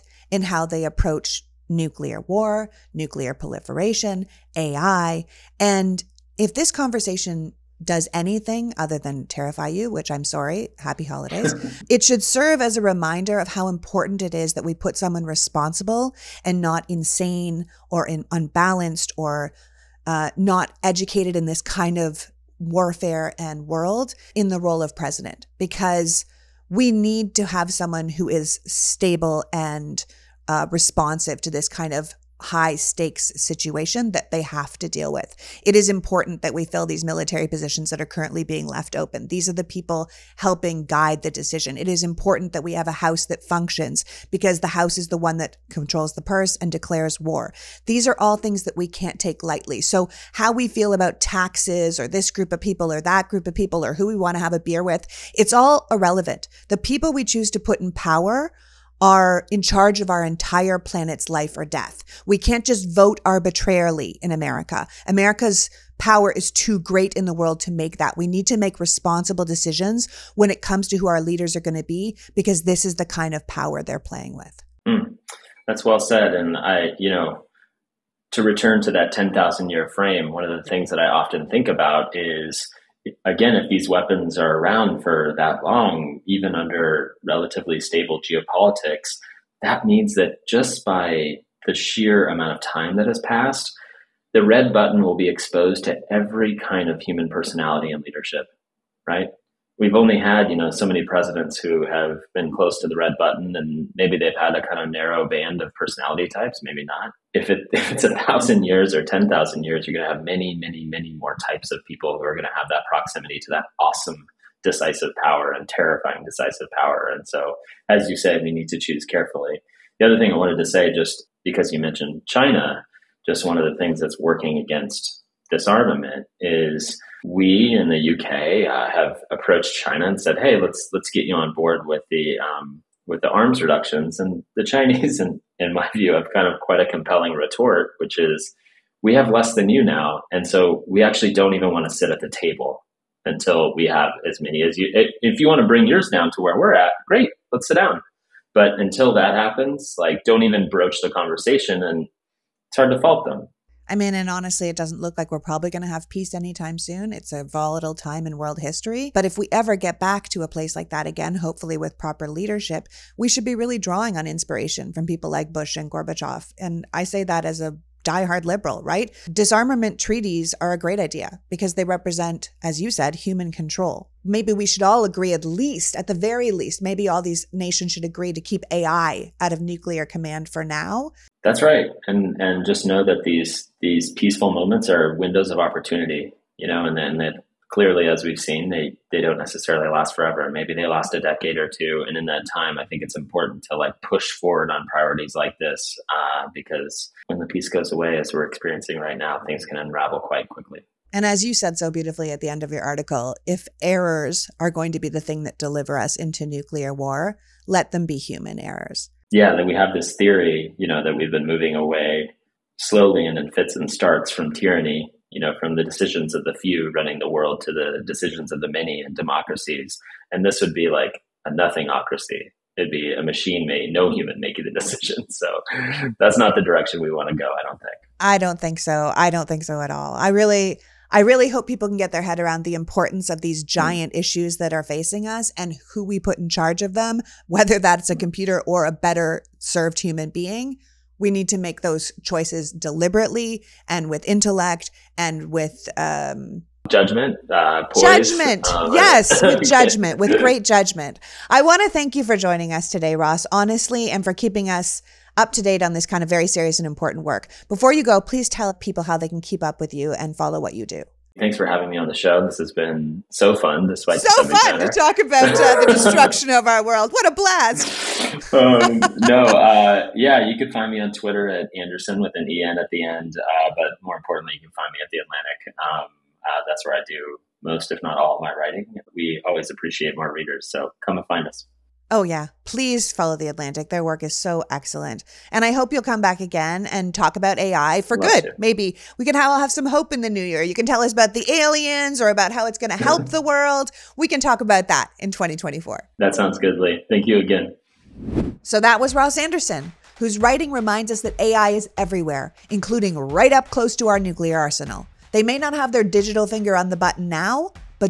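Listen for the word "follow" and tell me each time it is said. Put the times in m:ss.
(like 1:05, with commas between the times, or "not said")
4:20, 4:43.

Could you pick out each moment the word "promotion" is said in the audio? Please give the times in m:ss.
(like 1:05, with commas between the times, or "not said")
not said.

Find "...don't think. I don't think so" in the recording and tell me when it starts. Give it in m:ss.
3:47.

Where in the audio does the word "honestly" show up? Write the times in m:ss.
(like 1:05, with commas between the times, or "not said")
2:34, 4:13.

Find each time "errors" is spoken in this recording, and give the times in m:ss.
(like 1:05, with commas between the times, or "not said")
3:23, 3:28.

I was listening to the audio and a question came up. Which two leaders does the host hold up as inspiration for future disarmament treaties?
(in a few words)
Bush and Gorbachev.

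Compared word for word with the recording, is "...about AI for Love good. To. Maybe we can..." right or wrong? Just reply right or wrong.
right.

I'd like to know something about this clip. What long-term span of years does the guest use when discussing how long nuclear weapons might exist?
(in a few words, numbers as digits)
10,000 years.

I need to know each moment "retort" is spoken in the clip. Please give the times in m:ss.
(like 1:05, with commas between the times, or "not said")
2:17.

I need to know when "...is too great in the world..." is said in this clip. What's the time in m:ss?
1:06.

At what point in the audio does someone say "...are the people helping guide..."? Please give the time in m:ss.
0:39.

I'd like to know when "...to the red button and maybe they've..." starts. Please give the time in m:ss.
1:42.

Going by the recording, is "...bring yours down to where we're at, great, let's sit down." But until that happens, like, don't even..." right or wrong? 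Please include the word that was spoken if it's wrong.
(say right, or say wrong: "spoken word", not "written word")
right.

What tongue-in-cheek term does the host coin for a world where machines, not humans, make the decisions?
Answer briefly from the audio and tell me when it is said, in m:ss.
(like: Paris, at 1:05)
nothingocracy, at 3:41.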